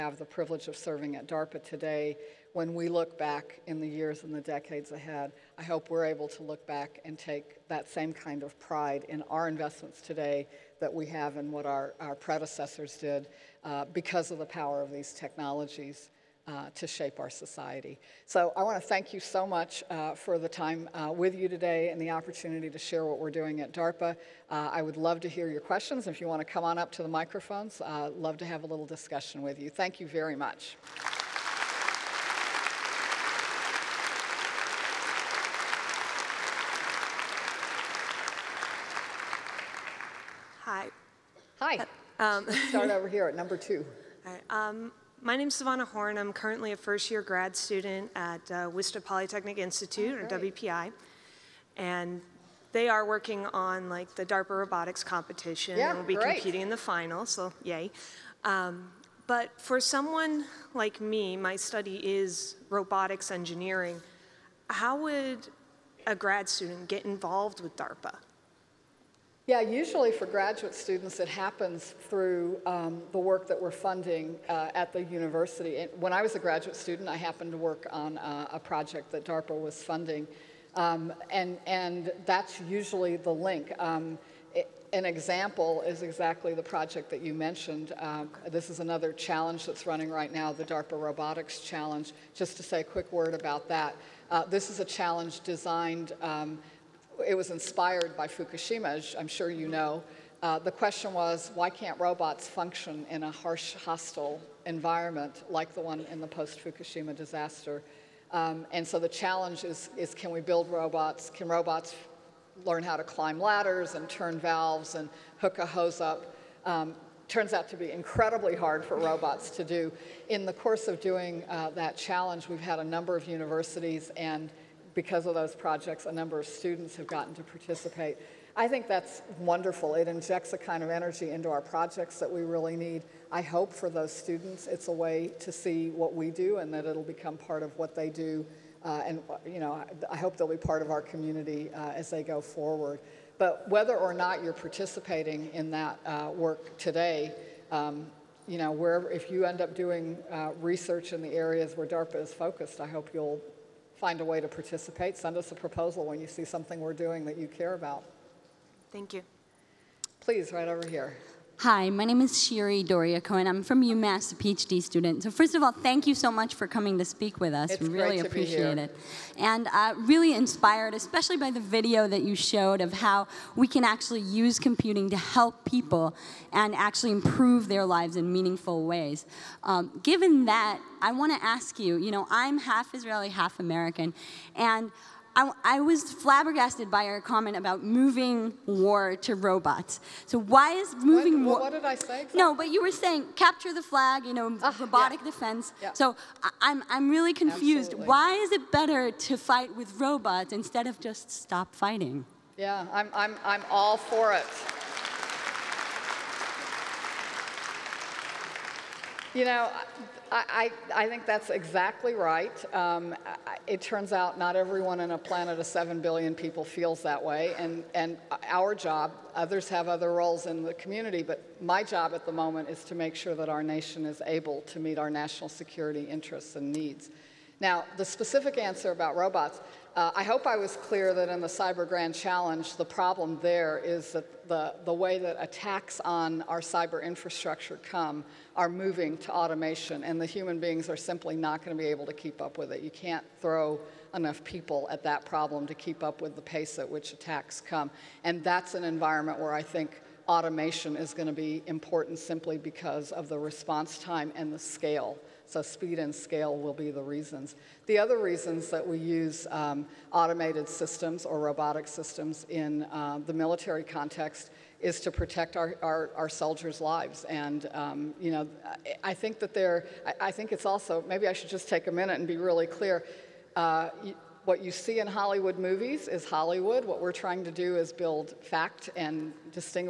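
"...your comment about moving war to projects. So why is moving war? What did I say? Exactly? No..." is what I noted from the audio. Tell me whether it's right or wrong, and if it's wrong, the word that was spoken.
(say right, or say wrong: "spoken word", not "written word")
wrong: "robots", not "projects".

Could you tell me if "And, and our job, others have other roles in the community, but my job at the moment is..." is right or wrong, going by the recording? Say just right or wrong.
right.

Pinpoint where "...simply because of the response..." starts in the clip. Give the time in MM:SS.
04:12.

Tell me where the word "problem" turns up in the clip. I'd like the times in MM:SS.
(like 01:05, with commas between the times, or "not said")
03:52, 04:05.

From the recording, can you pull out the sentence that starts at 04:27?
And, um, you know, I, think that there.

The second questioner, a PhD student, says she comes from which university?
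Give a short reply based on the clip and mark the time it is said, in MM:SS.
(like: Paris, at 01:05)
UMass, at 02:43.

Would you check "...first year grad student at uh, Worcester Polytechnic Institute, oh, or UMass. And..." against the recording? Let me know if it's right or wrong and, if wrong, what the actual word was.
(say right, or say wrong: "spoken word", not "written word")
wrong: "WPI", not "UMass".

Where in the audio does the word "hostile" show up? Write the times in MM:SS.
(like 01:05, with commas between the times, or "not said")
01:43.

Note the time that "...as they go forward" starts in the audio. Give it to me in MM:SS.
02:21.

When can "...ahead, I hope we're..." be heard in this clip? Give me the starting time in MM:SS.
00:04.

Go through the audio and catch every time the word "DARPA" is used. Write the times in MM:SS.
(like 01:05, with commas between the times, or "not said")
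00:01, 00:23, 00:54, 01:07, 01:19, 01:30, 02:31.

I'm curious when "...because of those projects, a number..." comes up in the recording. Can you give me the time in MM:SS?
02:04.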